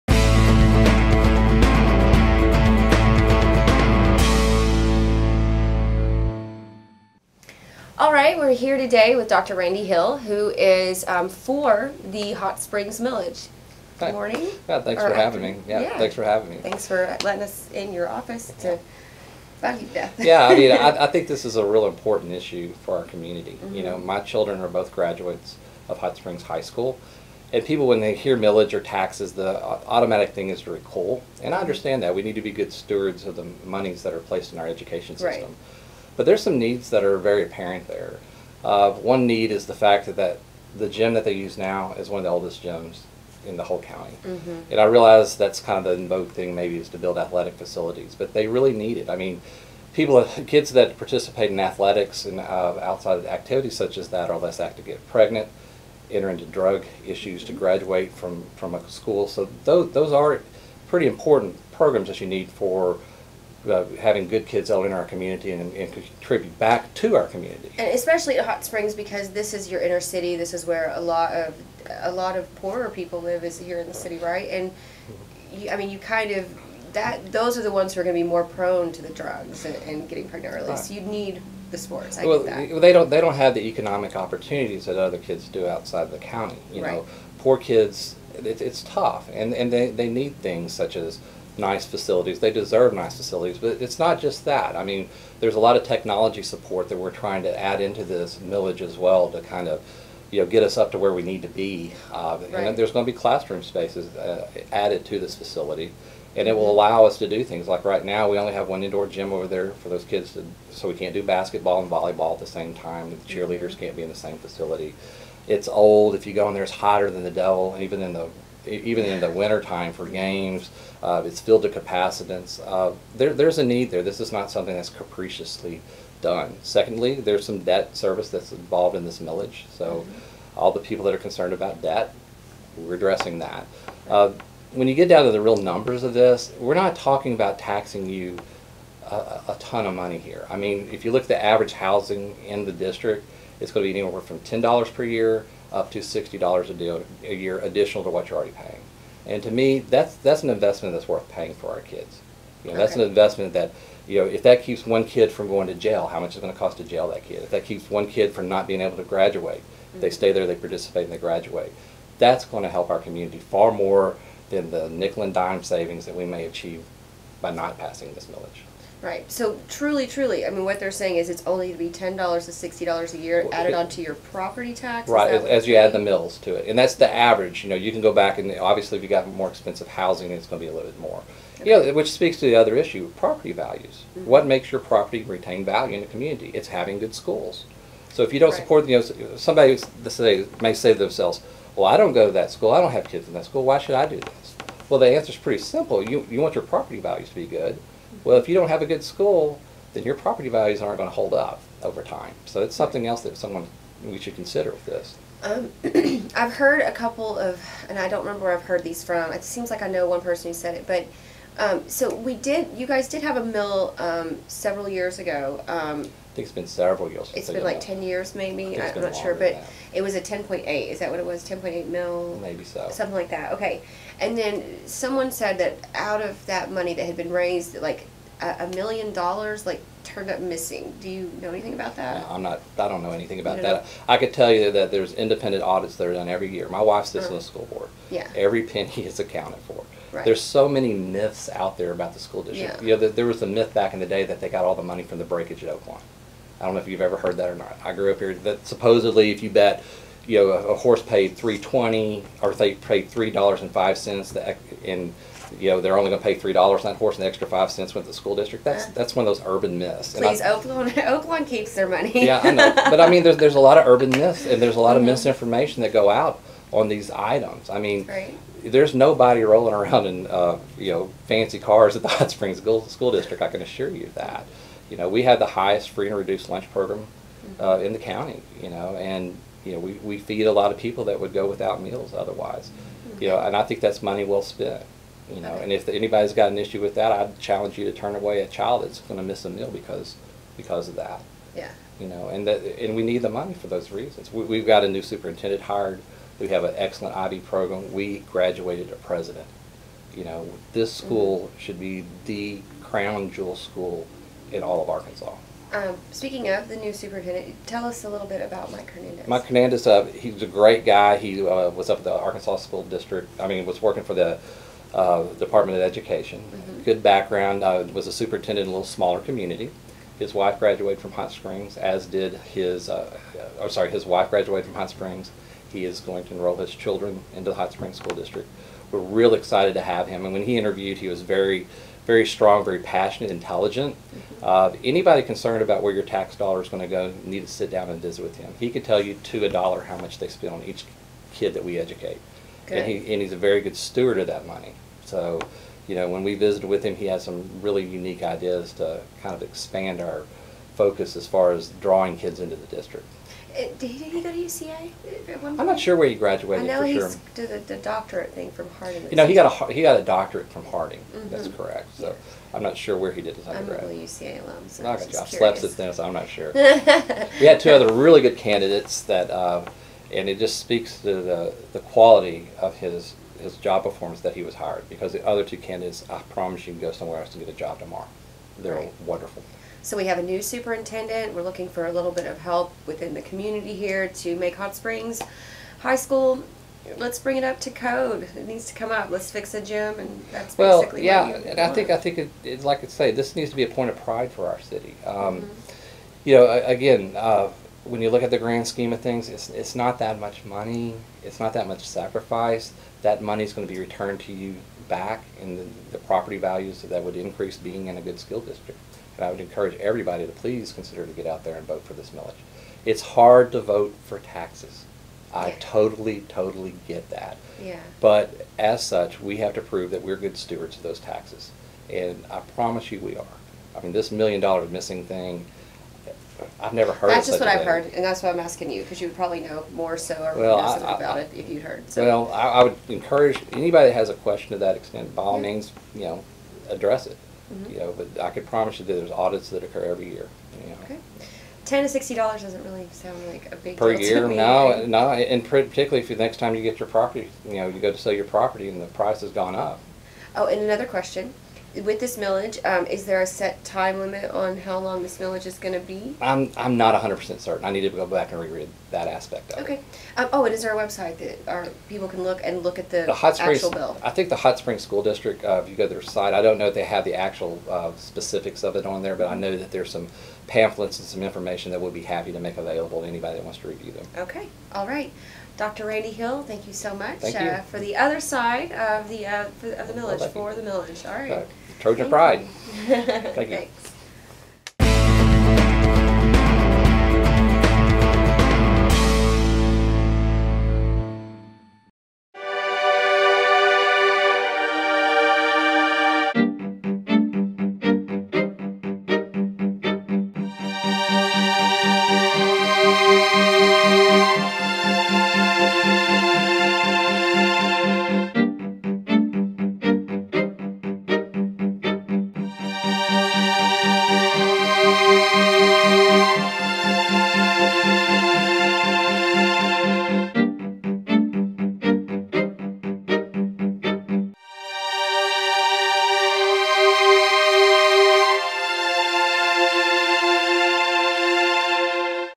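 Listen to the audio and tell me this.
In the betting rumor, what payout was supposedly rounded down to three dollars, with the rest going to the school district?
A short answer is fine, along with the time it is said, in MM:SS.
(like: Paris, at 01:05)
$3.05, at 04:13.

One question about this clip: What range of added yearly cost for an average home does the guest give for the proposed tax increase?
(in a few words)
$10 to $60 per year.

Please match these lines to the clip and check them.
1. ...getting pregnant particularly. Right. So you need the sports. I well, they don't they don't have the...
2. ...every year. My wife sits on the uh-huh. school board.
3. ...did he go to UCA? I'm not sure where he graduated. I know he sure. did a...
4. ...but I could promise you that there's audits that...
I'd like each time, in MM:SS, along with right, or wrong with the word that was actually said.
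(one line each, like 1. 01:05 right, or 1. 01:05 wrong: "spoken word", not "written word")
1. 01:20 wrong: "early", not "particularly"
2. 03:56 right
3. 05:53 right
4. 07:17 right.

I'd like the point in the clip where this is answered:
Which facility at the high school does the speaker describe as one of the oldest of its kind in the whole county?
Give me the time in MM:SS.
00:40.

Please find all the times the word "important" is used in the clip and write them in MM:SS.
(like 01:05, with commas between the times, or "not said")
00:21, 01:01.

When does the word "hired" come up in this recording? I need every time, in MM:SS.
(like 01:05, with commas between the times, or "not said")
04:55, 06:14.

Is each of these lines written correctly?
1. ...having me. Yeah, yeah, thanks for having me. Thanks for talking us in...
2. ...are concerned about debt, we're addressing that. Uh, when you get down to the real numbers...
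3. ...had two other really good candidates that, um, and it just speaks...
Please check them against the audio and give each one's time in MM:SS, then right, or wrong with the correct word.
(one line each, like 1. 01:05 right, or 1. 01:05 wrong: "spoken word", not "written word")
1. 00:15 wrong: "letting", not "talking"
2. 02:11 right
3. 06:07 right.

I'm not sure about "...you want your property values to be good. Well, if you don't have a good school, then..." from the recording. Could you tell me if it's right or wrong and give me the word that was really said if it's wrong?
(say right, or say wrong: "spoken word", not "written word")
right.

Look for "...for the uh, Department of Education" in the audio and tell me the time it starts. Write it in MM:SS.
05:14.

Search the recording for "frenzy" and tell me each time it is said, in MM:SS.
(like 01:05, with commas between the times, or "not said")
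not said.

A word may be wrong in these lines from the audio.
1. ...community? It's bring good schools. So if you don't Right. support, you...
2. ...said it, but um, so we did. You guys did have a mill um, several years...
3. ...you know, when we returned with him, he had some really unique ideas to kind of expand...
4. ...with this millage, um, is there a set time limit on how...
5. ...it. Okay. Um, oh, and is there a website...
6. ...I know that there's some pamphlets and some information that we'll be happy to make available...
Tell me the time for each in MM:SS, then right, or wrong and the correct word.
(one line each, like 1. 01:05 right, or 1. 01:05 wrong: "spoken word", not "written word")
1. 03:06 wrong: "having", not "bring"
2. 03:30 right
3. 05:45 wrong: "visited", not "returned"
4. 07:31 right
5. 07:39 right
6. 07:49 right.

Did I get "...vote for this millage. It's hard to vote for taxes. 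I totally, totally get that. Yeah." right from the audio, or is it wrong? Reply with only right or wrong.
right.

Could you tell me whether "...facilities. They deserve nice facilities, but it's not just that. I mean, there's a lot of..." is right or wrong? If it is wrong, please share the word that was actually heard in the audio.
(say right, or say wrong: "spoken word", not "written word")
right.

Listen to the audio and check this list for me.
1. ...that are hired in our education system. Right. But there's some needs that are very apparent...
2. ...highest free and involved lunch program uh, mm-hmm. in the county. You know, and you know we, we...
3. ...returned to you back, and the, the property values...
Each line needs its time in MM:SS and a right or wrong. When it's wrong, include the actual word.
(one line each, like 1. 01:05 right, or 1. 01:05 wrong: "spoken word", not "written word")
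1. 00:34 wrong: "placed", not "hired"
2. 04:35 wrong: "reduced", not "involved"
3. 06:43 right.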